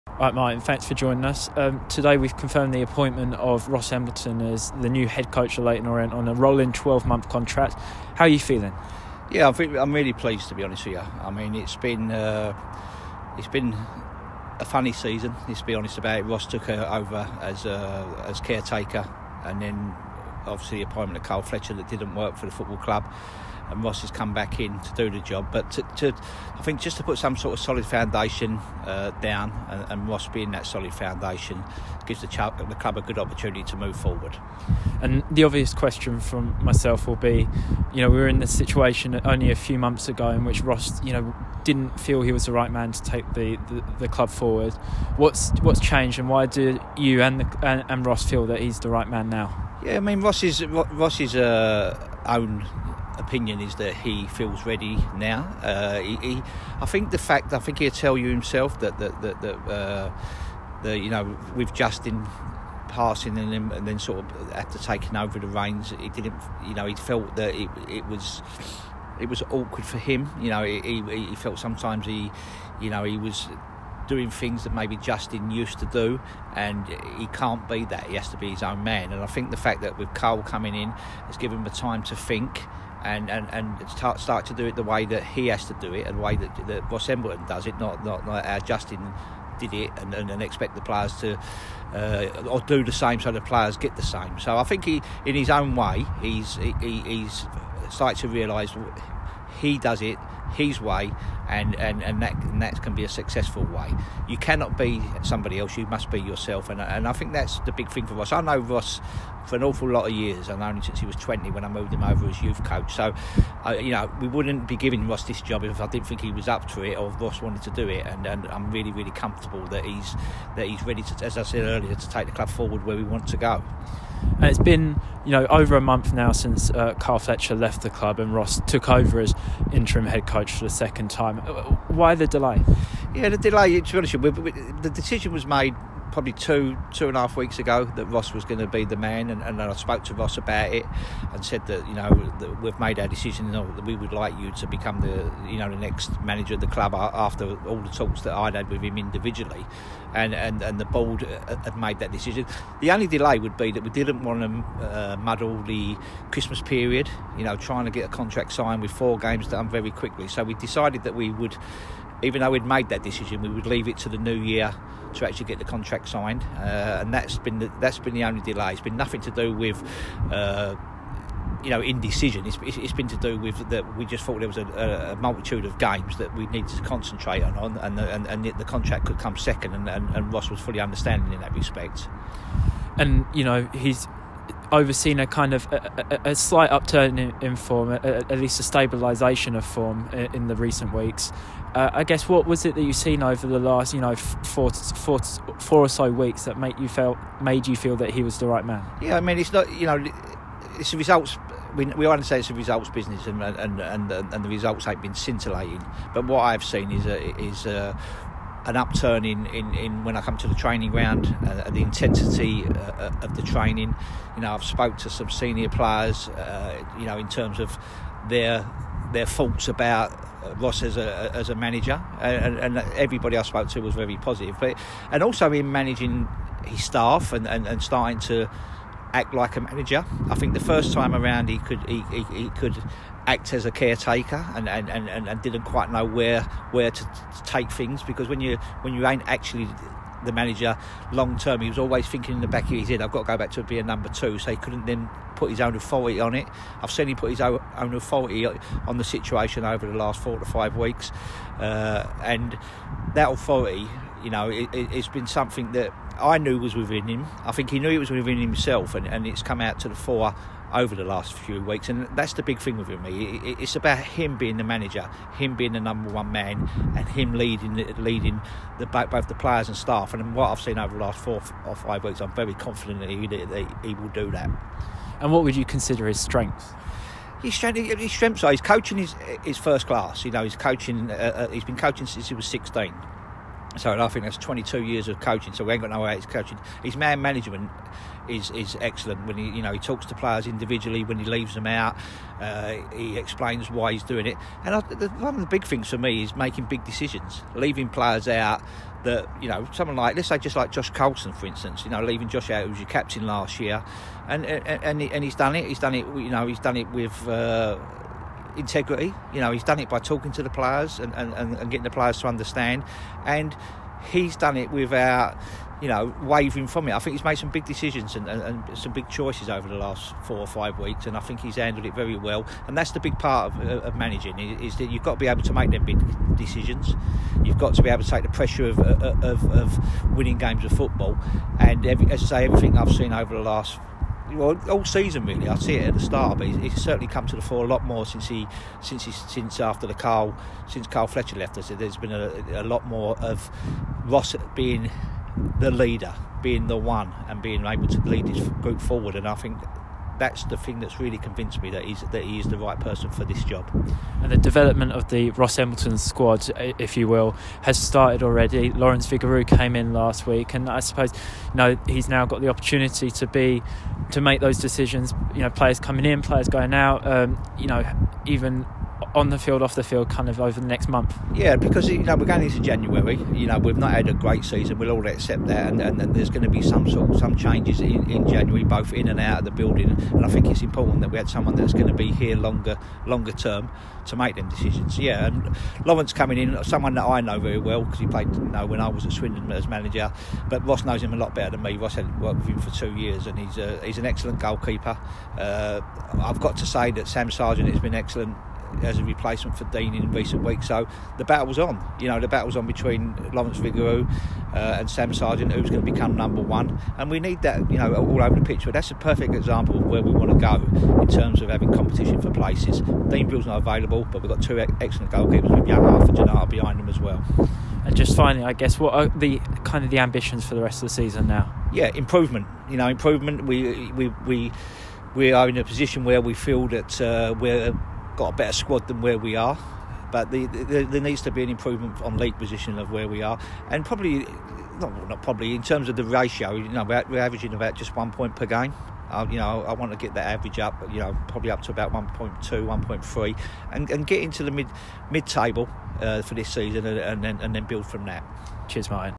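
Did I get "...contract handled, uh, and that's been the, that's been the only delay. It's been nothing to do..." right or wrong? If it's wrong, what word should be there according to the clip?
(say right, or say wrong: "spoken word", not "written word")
wrong: "signed", not "handled".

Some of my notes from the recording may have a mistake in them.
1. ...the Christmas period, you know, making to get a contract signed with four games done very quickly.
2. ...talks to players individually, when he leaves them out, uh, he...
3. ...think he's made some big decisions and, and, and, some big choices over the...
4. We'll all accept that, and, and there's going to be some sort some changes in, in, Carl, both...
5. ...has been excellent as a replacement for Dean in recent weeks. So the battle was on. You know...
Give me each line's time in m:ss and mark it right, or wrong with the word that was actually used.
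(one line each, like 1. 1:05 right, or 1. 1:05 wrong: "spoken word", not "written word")
1. 2:35 wrong: "trying", not "making"
2. 4:49 right
3. 5:16 right
4. 6:14 wrong: "January", not "Carl"
5. 6:37 right.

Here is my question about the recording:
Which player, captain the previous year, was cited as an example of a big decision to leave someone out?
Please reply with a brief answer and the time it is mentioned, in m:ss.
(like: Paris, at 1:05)
Josh Coulson, at 5:00.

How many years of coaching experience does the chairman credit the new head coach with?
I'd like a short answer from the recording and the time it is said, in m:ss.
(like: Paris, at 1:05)
22 years, at 4:44.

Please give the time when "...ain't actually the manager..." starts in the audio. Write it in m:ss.
3:59.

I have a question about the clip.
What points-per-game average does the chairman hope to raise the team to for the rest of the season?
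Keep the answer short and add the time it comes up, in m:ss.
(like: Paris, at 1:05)
1.2 to 1.3, at 7:21.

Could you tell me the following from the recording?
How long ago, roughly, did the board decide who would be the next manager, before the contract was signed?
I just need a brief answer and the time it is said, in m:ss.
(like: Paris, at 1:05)
2 to 2.5 weeks, at 2:16.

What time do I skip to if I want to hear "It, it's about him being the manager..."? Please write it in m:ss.
4:23.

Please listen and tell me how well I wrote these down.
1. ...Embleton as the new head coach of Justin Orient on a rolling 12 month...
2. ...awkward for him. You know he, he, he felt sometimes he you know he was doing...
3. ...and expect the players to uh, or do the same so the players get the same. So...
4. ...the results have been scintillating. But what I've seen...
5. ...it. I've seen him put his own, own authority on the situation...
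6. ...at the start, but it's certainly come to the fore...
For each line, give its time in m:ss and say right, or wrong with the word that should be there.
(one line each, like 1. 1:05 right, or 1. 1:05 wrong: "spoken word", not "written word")
1. 0:03 wrong: "Leyton", not "Justin"
2. 1:09 right
3. 1:30 right
4. 3:24 right
5. 4:06 right
6. 5:35 right.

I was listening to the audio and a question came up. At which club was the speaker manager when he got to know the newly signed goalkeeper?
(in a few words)
Swindon.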